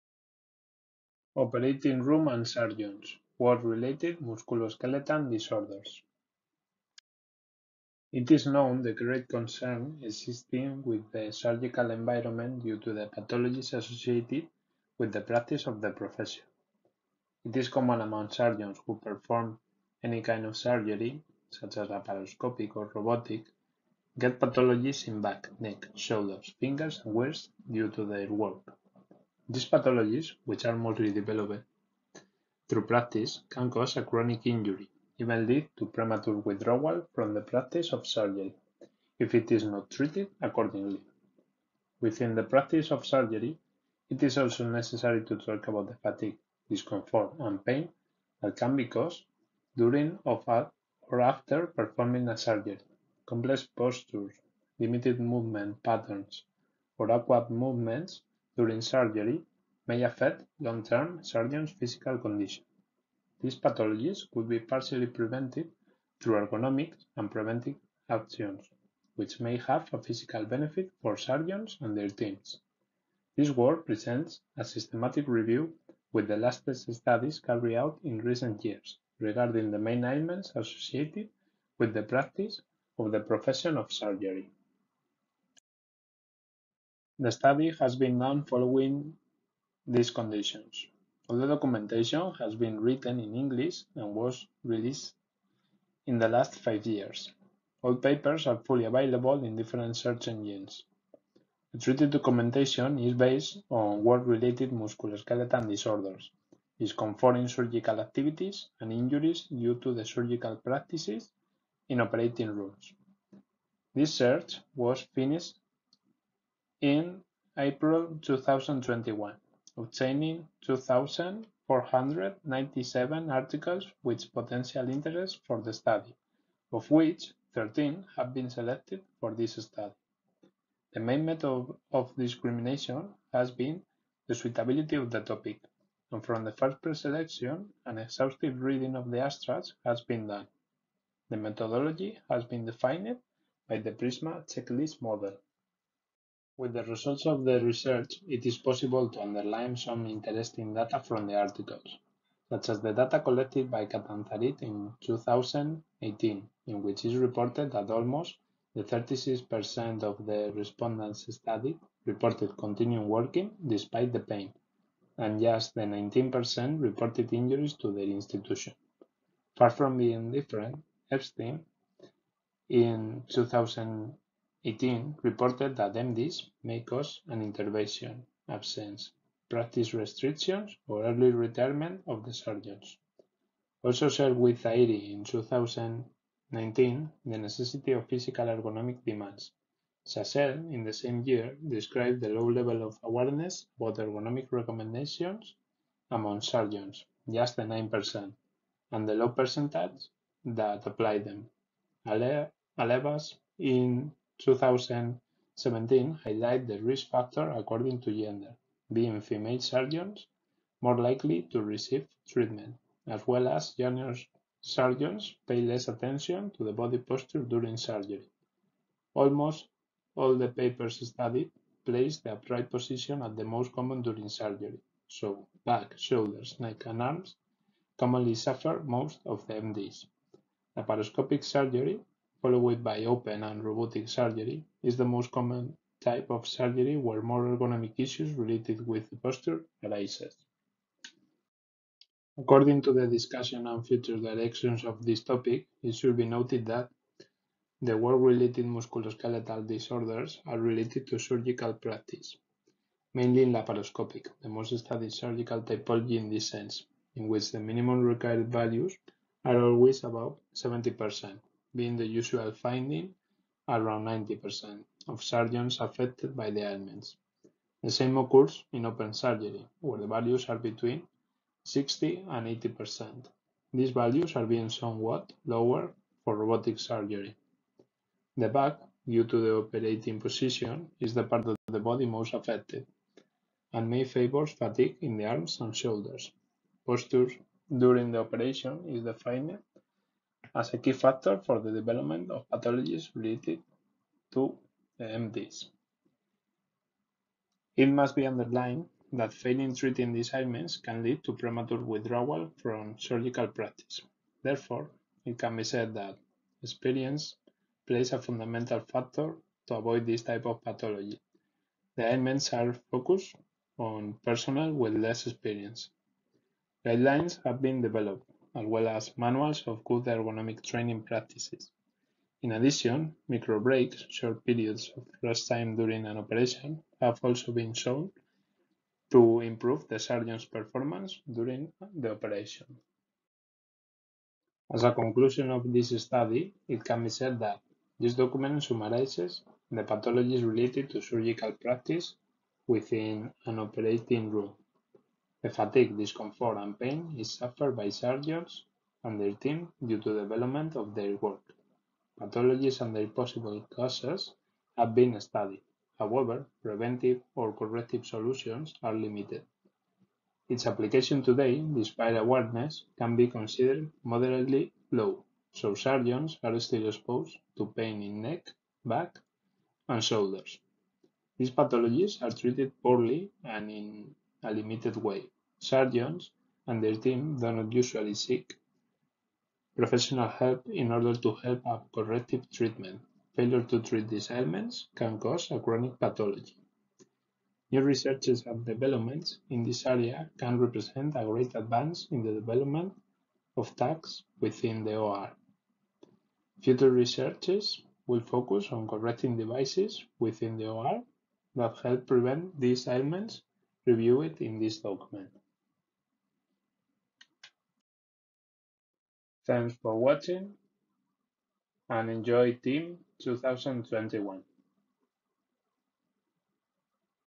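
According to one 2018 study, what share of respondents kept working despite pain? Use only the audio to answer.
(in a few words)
36%.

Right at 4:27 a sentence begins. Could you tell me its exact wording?
The same occurs in open surgery, where the values are between 60 and 80%.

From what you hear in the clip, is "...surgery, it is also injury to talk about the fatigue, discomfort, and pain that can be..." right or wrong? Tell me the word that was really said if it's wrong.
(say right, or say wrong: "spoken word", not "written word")
wrong: "necessary", not "injury".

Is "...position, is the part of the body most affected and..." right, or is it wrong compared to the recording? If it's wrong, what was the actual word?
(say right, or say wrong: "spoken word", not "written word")
right.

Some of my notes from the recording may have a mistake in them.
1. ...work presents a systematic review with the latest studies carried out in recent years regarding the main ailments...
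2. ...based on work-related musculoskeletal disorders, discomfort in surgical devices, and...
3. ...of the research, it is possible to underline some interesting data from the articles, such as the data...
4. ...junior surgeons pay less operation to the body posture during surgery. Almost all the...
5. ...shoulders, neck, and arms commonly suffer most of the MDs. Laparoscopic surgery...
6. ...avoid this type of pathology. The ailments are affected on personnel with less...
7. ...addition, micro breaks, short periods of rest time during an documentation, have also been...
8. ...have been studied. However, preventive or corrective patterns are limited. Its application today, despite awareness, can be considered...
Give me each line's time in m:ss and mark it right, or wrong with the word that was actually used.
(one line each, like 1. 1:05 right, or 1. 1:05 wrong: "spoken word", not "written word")
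1. 1:13 right
2. 1:43 wrong: "activities", not "devices"
3. 2:27 right
4. 3:33 wrong: "attention", not "operation"
5. 3:45 right
6. 5:09 wrong: "focused", not "affected"
7. 5:22 wrong: "operation", not "documentation"
8. 5:54 wrong: "solutions", not "patterns".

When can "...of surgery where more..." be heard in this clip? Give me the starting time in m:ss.
3:56.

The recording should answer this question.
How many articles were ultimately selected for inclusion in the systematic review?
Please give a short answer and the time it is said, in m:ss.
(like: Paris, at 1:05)
13, at 2:07.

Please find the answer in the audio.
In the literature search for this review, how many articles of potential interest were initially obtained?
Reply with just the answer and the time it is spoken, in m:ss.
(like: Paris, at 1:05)
2,497, at 2:00.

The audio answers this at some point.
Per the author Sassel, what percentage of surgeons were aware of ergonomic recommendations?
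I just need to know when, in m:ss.
3:17.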